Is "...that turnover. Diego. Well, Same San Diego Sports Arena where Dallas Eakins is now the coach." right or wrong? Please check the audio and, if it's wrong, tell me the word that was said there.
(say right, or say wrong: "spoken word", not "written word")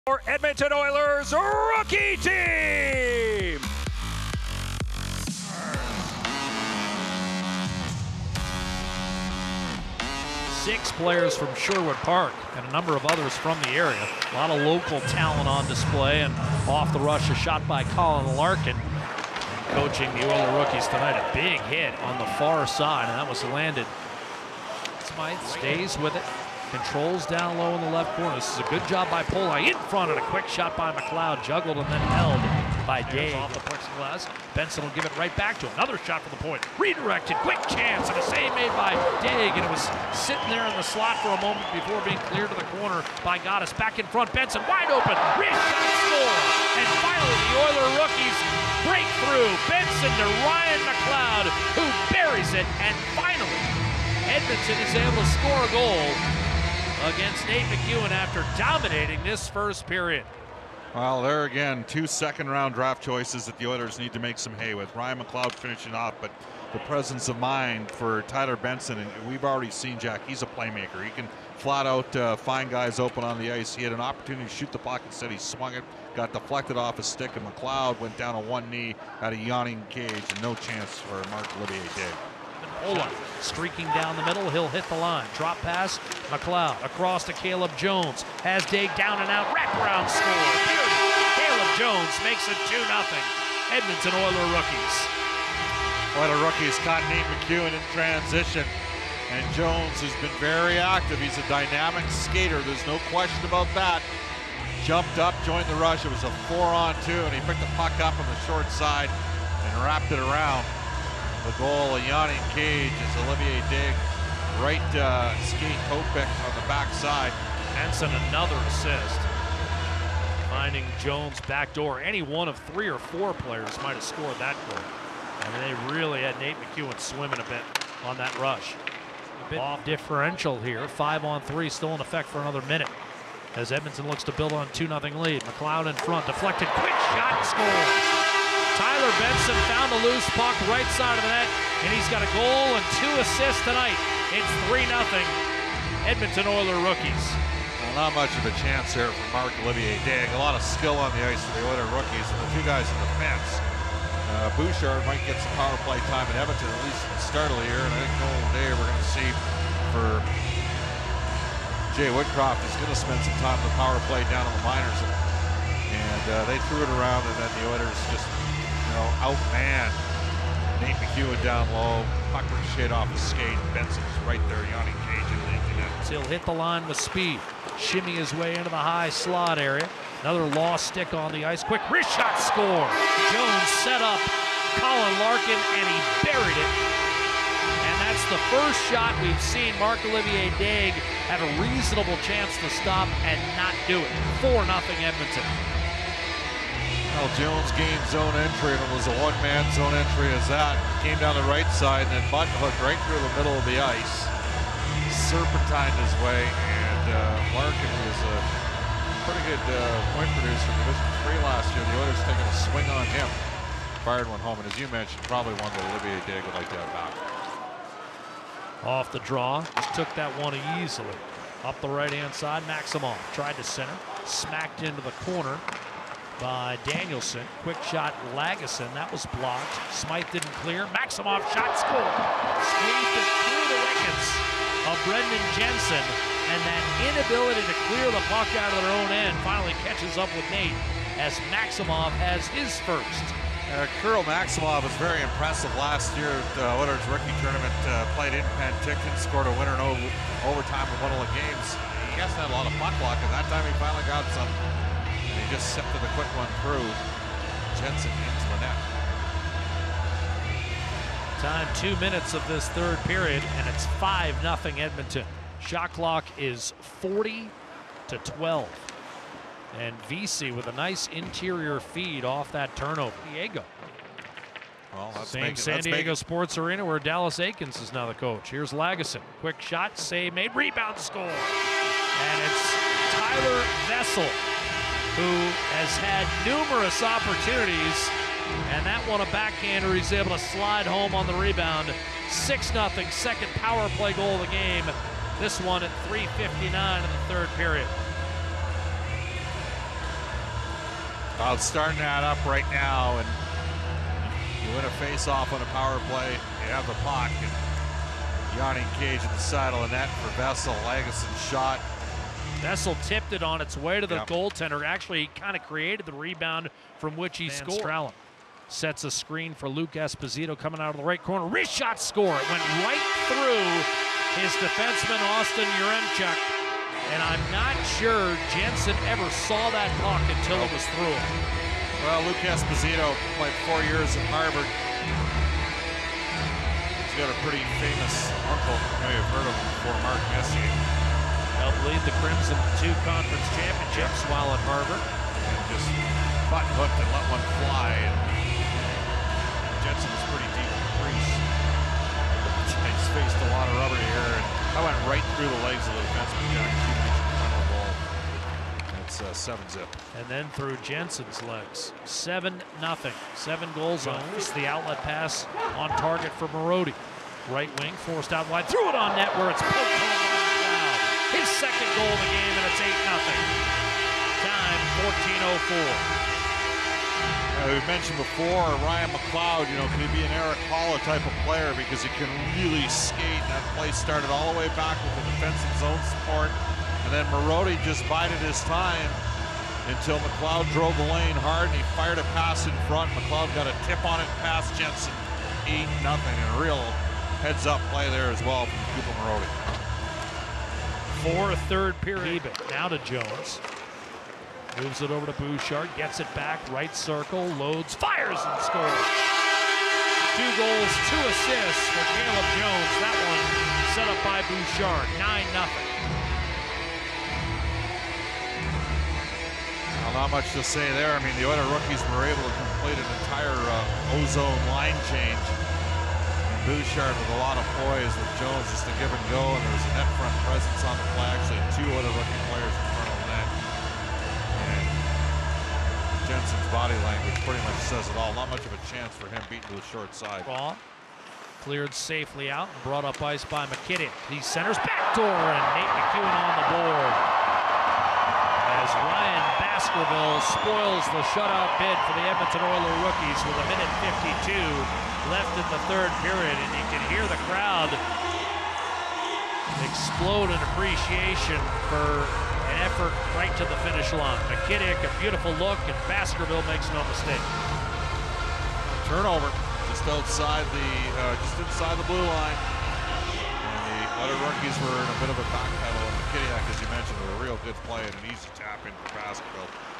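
right.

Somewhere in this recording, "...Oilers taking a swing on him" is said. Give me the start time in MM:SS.
03:31.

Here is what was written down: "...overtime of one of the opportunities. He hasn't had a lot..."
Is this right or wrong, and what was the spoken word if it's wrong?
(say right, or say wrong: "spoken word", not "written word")
wrong: "games", not "opportunities".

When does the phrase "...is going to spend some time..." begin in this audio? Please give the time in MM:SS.
02:42.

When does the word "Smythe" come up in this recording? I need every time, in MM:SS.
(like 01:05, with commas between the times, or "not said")
00:25, 03:49.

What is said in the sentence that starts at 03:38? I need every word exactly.
Off the draw, just took that one easily.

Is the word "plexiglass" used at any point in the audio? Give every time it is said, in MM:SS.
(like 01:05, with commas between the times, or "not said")
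00:33.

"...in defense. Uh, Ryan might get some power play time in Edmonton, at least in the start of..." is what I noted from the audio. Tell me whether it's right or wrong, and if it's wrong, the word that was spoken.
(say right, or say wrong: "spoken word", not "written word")
wrong: "Bouchard", not "Ryan".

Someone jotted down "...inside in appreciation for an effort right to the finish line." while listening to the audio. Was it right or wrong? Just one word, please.
wrong.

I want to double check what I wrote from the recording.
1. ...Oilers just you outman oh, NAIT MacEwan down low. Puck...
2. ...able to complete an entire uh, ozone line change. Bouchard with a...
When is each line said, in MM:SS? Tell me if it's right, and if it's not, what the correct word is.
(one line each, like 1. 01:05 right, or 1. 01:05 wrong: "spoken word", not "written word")
1. 02:47 right
2. 07:02 right.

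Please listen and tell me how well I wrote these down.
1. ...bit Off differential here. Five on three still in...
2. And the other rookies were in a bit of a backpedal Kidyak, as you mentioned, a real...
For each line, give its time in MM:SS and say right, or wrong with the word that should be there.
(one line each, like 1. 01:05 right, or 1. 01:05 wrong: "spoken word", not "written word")
1. 02:09 right
2. 07:53 right.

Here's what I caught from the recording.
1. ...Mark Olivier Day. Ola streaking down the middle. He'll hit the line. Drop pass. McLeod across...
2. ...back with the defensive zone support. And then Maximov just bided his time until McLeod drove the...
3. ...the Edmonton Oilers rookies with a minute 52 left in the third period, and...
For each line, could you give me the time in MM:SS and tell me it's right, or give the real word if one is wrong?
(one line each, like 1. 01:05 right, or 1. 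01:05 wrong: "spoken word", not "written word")
1. 01:21 right
2. 06:24 wrong: "Marody", not "Maximov"
3. 07:32 right.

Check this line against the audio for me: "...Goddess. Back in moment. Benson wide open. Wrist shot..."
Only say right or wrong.
wrong.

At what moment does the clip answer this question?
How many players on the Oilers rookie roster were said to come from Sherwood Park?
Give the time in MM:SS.
00:10.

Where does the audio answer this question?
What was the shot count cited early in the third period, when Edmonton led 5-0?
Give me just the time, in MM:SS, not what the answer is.
04:27.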